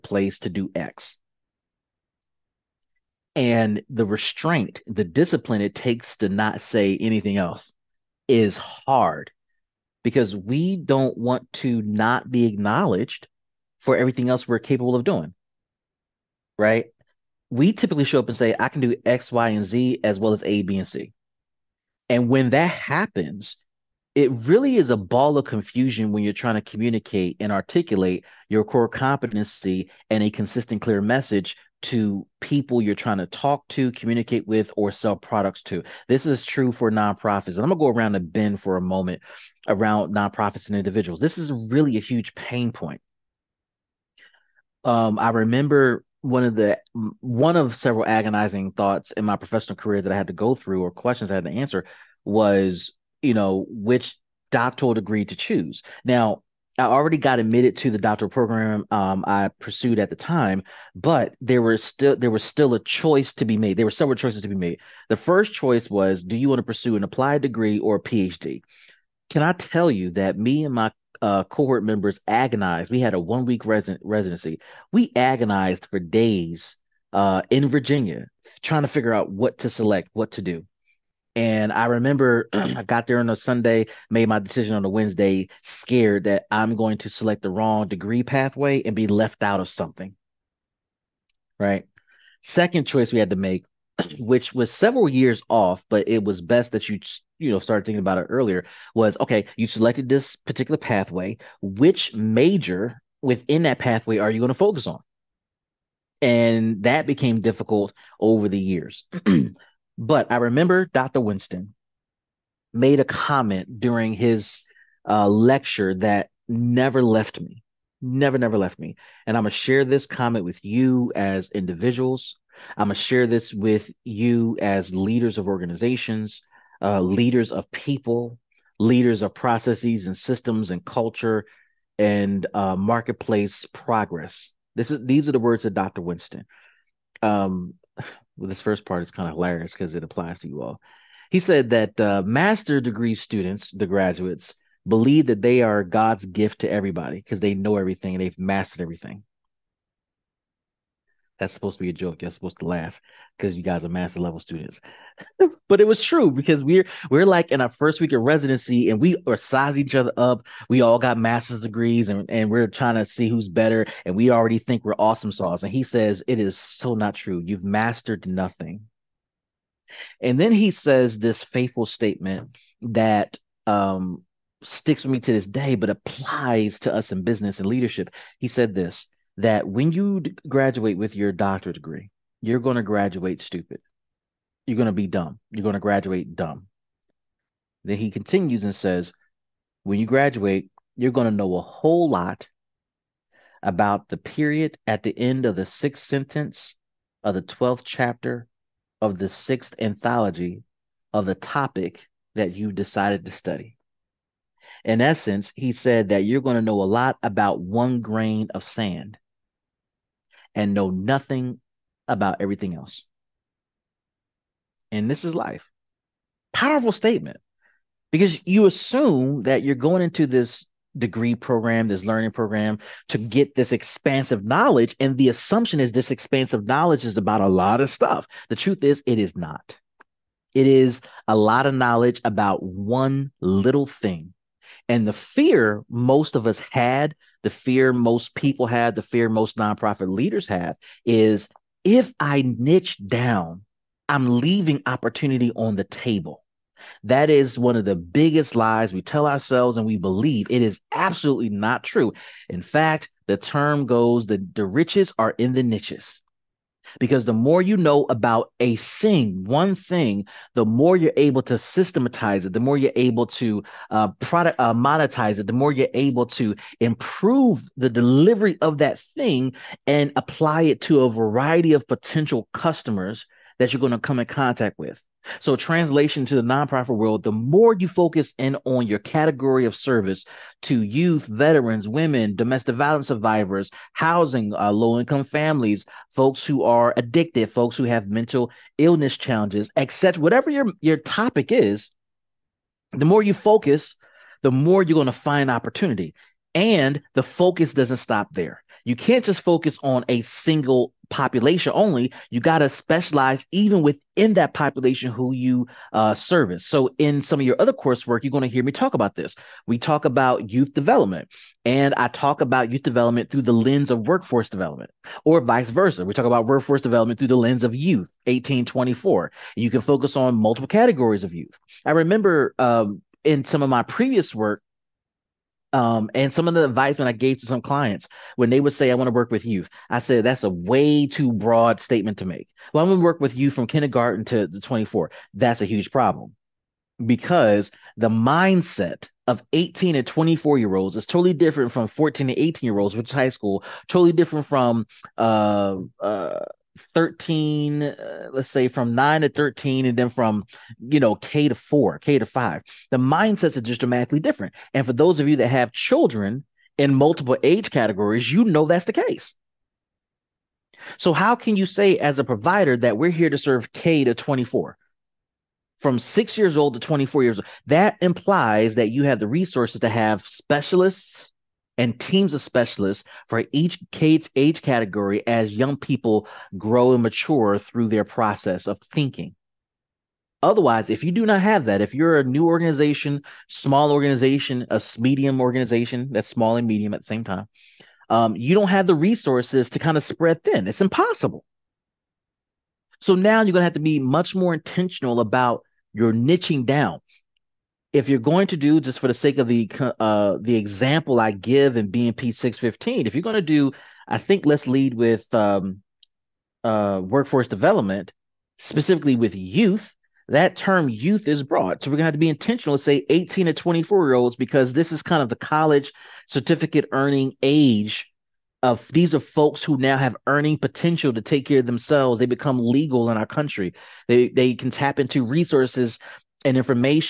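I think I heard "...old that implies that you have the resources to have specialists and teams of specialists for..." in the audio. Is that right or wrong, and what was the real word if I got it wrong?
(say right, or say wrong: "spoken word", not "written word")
right.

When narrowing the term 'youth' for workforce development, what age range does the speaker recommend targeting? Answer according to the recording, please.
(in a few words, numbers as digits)
18 to 24.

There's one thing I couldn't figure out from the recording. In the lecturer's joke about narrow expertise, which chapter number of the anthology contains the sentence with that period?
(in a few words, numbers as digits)
12th.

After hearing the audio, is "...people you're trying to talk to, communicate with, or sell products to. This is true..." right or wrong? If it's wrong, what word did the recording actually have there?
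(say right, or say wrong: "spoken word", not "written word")
right.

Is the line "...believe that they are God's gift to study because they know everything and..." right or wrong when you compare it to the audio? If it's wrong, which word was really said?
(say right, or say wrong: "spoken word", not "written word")
wrong: "everybody", not "study".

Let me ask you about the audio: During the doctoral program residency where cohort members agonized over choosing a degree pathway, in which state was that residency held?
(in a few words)
Virginia.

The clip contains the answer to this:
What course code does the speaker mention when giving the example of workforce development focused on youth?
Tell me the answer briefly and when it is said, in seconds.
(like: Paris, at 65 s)
BMP 615, at 401 s.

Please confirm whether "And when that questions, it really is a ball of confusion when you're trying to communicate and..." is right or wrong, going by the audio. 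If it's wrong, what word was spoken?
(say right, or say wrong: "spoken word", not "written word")
wrong: "happens", not "questions".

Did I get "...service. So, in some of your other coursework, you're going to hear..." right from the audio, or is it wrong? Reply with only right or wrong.
right.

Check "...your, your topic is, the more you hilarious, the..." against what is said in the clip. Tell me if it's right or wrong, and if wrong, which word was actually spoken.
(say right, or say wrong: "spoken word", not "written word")
wrong: "focus", not "hilarious".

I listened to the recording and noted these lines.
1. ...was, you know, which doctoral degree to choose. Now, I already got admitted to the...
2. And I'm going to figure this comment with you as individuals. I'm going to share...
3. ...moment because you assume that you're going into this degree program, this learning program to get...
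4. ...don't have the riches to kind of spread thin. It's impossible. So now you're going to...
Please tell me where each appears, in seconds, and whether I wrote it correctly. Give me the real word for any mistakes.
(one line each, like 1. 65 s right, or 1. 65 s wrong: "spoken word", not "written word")
1. 52 s right
2. 119 s wrong: "share", not "figure"
3. 216 s wrong: "statement", not "moment"
4. 388 s wrong: "resources", not "riches".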